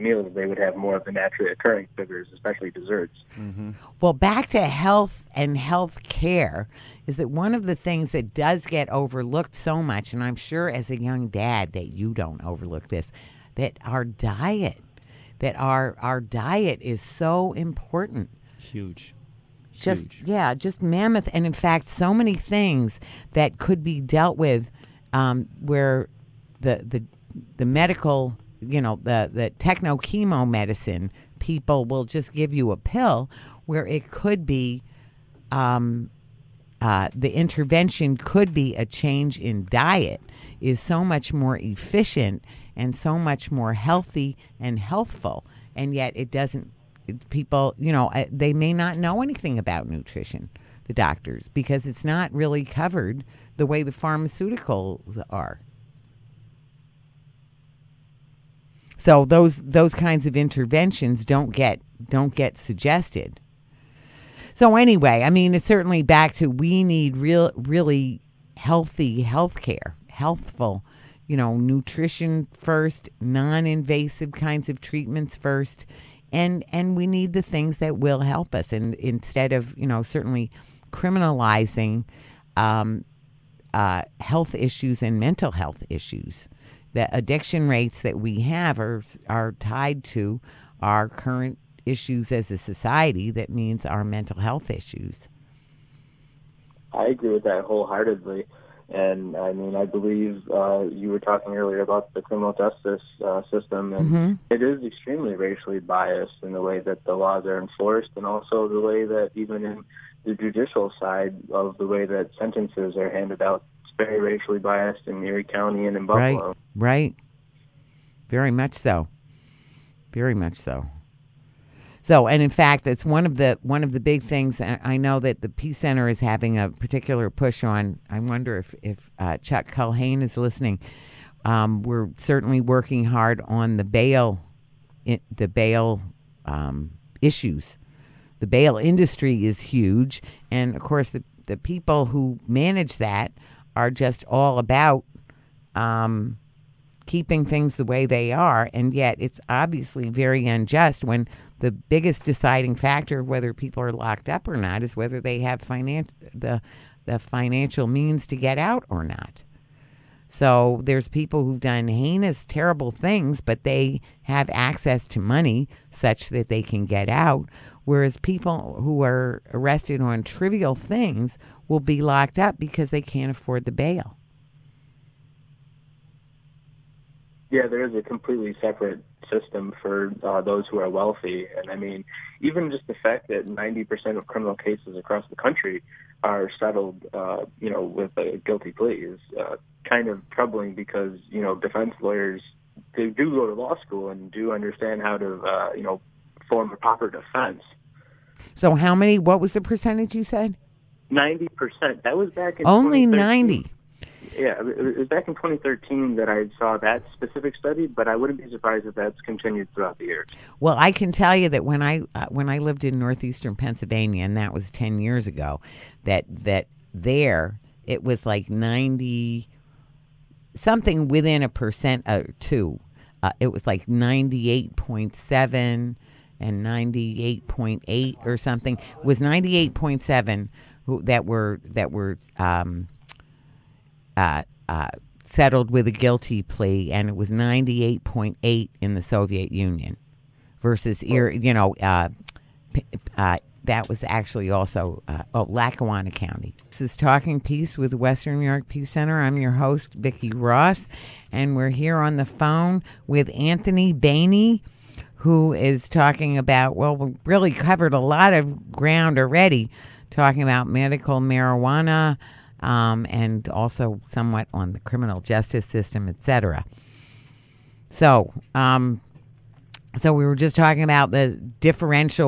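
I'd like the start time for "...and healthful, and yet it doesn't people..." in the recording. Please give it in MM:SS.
00:44.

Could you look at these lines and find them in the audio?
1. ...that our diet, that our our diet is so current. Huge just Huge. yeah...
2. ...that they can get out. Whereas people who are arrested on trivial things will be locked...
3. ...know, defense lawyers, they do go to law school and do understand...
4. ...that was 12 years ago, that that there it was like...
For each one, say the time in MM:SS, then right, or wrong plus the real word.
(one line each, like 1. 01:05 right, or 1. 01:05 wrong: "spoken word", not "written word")
1. 00:13 wrong: "important", not "current"
2. 02:46 right
3. 03:11 right
4. 03:34 wrong: "10", not "12".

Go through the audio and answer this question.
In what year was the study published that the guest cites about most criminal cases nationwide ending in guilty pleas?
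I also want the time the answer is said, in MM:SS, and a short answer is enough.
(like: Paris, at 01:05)
2013, at 03:25.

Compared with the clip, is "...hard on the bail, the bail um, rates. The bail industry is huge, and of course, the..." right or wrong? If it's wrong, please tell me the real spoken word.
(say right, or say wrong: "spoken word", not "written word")
wrong: "issues", not "rates".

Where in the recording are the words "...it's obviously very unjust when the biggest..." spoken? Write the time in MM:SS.
02:29.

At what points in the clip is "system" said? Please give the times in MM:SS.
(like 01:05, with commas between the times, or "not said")
01:43, 02:59, 04:25.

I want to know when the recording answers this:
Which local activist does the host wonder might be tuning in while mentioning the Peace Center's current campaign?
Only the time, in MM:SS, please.
02:09.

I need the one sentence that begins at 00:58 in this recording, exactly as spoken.
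So those those kinds of interventions don't get don't get suggested.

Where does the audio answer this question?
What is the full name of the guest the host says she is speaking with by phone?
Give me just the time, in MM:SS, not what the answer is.
04:13.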